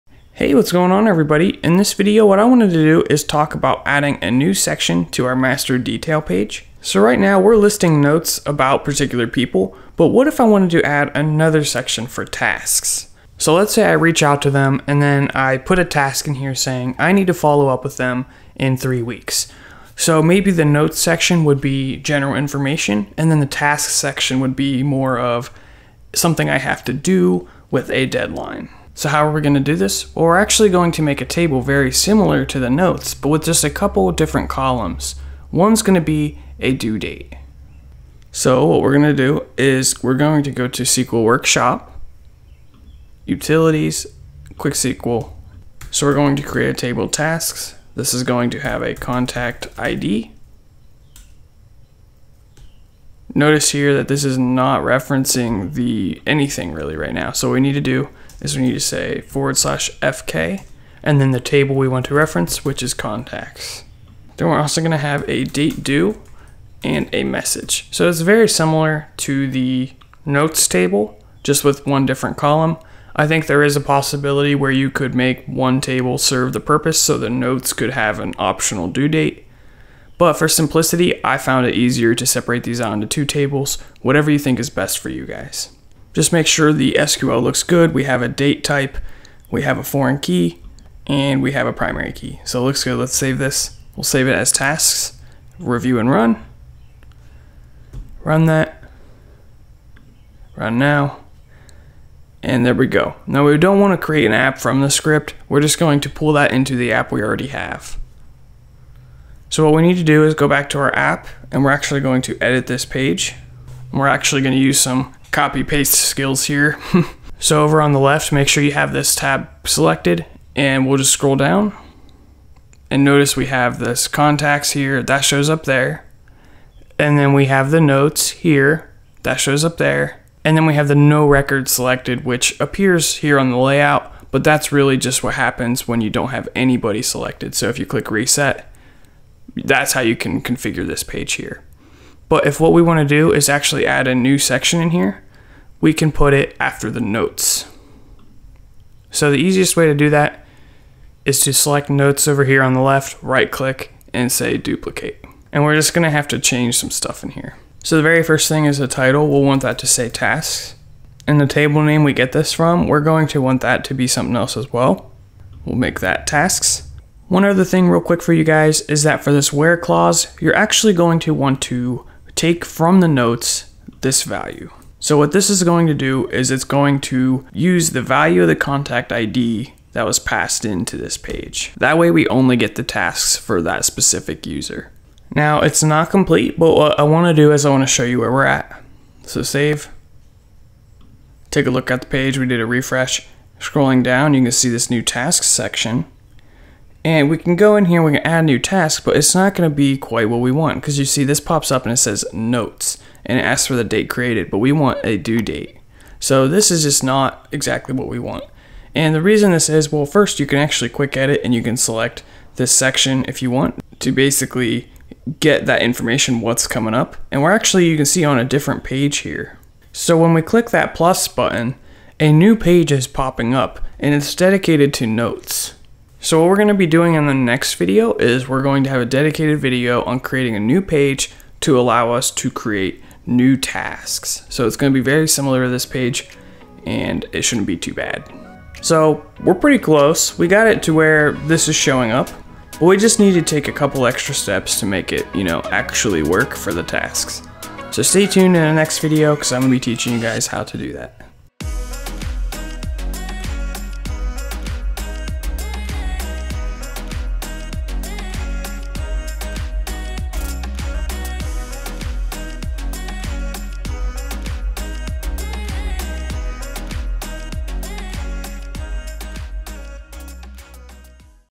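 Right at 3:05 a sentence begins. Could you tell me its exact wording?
Now it's not complete, but what I wanna do is I wanna show you where we're at.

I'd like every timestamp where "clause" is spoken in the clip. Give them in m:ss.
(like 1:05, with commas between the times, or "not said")
2:49.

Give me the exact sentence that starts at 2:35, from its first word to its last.
And we're just gonna have to change some stuff in here.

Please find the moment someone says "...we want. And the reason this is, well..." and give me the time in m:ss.
3:28.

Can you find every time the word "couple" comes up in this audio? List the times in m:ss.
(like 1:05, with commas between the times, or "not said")
0:33, 4:03.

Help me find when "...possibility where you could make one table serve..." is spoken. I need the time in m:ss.
1:13.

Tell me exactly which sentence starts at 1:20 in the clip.
But for simplicity, I found it easier to separate these out into two tables, whatever you think is best for you guys.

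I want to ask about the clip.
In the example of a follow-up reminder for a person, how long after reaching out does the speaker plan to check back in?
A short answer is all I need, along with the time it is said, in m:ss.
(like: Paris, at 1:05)
3 weeks, at 0:18.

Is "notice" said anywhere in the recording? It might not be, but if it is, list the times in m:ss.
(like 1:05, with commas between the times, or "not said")
0:53, 2:03.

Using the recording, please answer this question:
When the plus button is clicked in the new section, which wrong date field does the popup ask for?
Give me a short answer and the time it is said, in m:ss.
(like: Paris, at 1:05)
date created, at 3:23.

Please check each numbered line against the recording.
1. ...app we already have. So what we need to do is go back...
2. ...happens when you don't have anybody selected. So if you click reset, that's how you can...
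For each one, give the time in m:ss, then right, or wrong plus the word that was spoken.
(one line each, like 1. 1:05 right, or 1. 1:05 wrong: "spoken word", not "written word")
1. 1:46 right
2. 2:15 right.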